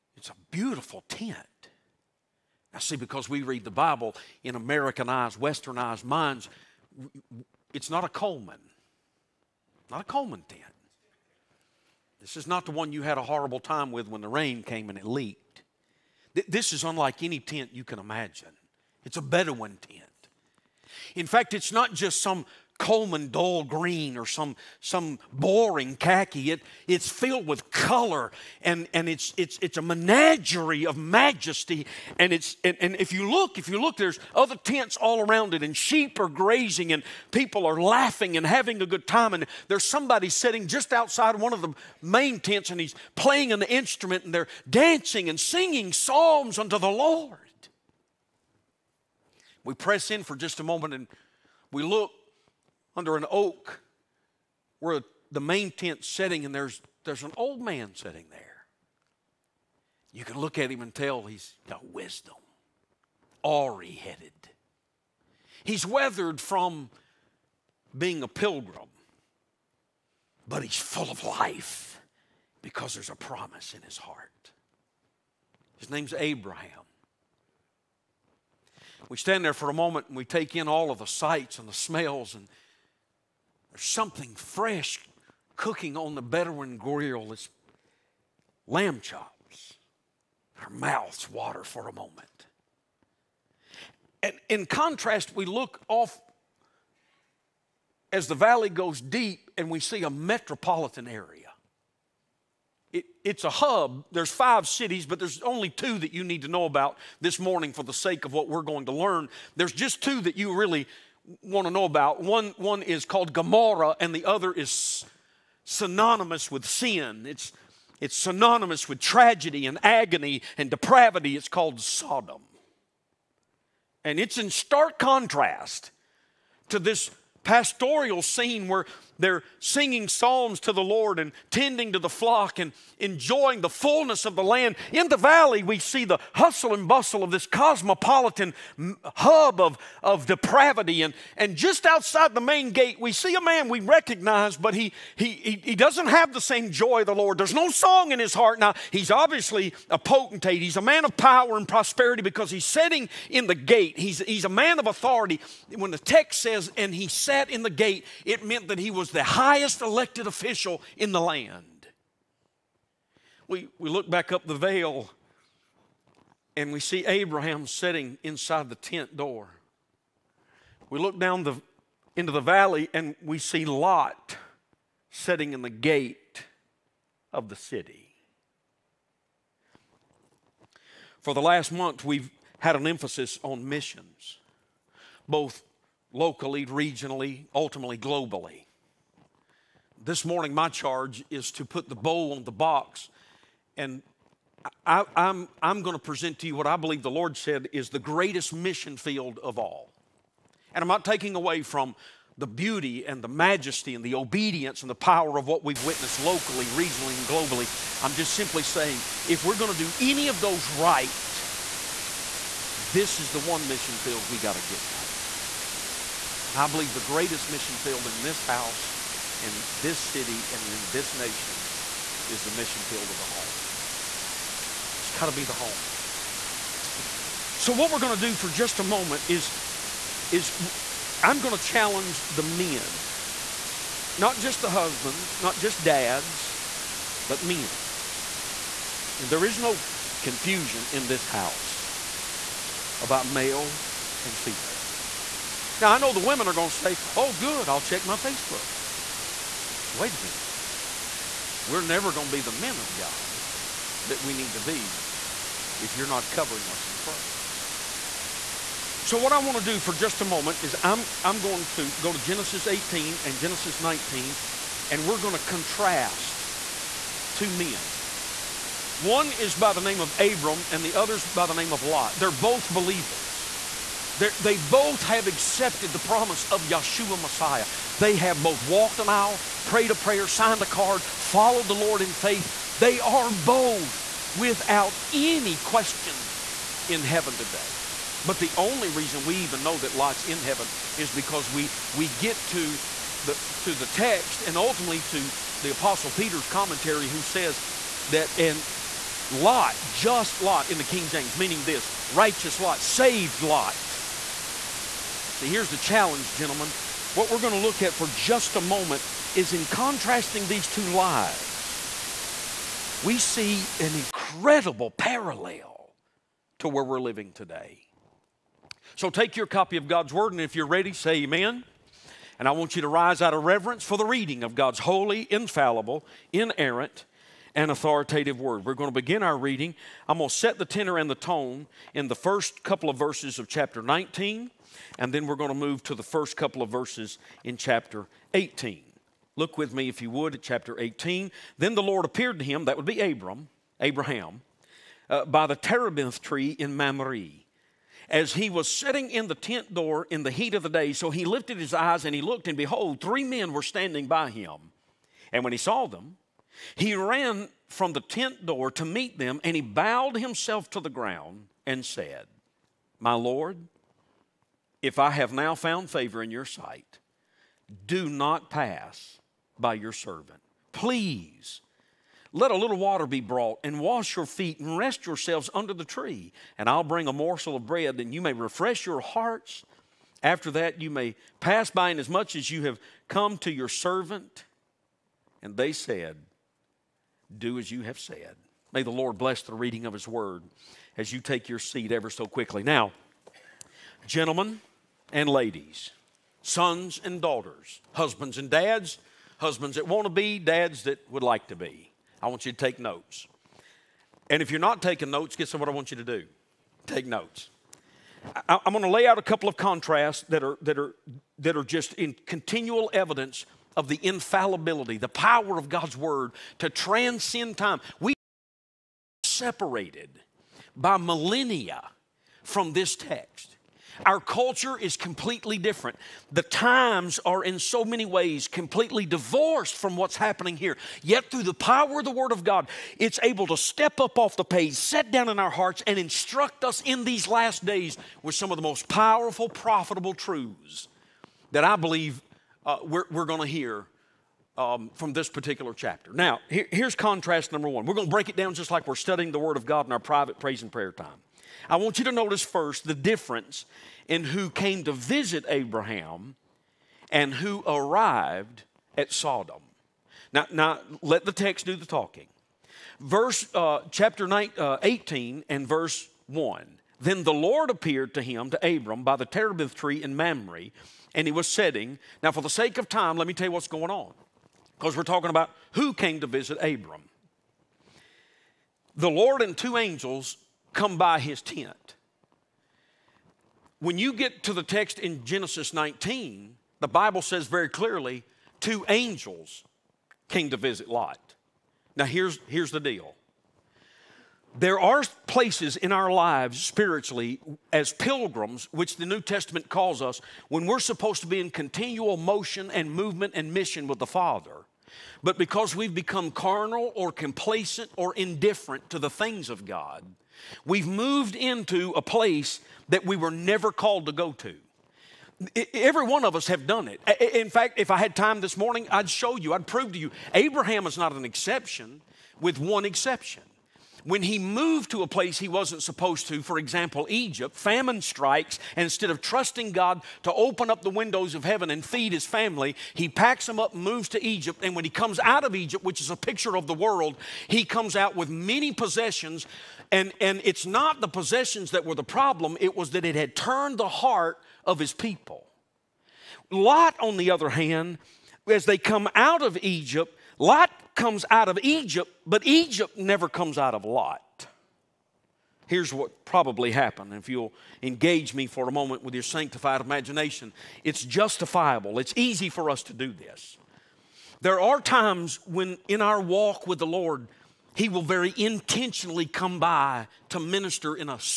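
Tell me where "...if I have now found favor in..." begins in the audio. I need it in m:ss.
6:04.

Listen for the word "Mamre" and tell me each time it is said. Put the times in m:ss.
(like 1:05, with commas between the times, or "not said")
5:46, 7:50.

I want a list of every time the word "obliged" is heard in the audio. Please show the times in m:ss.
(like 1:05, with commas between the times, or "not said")
not said.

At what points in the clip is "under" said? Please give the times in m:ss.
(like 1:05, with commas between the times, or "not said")
0:52, 6:15.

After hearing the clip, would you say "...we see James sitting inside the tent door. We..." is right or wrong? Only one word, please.
wrong.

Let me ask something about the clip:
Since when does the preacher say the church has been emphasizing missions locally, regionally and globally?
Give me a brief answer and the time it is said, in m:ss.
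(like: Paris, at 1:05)
Last month, at 3:01.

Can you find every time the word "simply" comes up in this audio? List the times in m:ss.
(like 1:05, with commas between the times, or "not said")
3:28.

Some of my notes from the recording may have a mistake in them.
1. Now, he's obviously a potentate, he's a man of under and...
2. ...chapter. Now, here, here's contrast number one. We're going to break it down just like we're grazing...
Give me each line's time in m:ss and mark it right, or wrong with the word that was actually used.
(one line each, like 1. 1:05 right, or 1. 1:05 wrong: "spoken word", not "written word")
1. 2:28 wrong: "power", not "under"
2. 7:25 wrong: "studying", not "grazing".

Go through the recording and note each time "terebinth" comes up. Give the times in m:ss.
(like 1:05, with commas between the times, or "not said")
5:45, 7:49.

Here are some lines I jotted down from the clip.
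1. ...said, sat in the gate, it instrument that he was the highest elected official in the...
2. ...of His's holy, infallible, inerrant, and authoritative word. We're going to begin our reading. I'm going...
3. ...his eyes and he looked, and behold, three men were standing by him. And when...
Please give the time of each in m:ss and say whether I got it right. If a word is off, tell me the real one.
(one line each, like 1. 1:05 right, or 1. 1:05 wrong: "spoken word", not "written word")
1. 2:37 wrong: "meant", not "instrument"
2. 5:24 wrong: "God", not "His"
3. 5:51 right.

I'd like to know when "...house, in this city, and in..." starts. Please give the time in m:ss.
3:38.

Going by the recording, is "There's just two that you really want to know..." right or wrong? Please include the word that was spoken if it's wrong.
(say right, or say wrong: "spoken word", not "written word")
right.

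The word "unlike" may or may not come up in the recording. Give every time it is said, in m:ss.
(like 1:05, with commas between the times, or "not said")
0:16.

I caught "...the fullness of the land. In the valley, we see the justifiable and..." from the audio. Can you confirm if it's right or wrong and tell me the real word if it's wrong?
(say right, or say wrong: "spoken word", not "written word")
wrong: "hustle", not "justifiable".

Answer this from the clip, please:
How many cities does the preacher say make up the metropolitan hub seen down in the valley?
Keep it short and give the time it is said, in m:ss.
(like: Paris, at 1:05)
5, at 1:44.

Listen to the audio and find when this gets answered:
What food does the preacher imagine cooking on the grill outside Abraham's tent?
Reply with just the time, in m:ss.
1:28.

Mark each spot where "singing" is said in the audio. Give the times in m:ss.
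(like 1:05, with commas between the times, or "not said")
0:45, 2:09.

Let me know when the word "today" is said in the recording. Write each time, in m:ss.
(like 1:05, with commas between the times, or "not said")
4:47, 5:17.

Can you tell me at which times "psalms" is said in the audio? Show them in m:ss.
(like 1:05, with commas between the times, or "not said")
0:45, 2:10.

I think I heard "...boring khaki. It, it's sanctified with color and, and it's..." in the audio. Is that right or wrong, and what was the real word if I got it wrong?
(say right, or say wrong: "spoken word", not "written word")
wrong: "filled", not "sanctified".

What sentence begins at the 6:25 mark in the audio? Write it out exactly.
And they said, Do as you have said.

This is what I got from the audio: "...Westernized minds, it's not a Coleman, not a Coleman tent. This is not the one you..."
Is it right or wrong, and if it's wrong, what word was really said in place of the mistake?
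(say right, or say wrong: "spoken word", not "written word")
right.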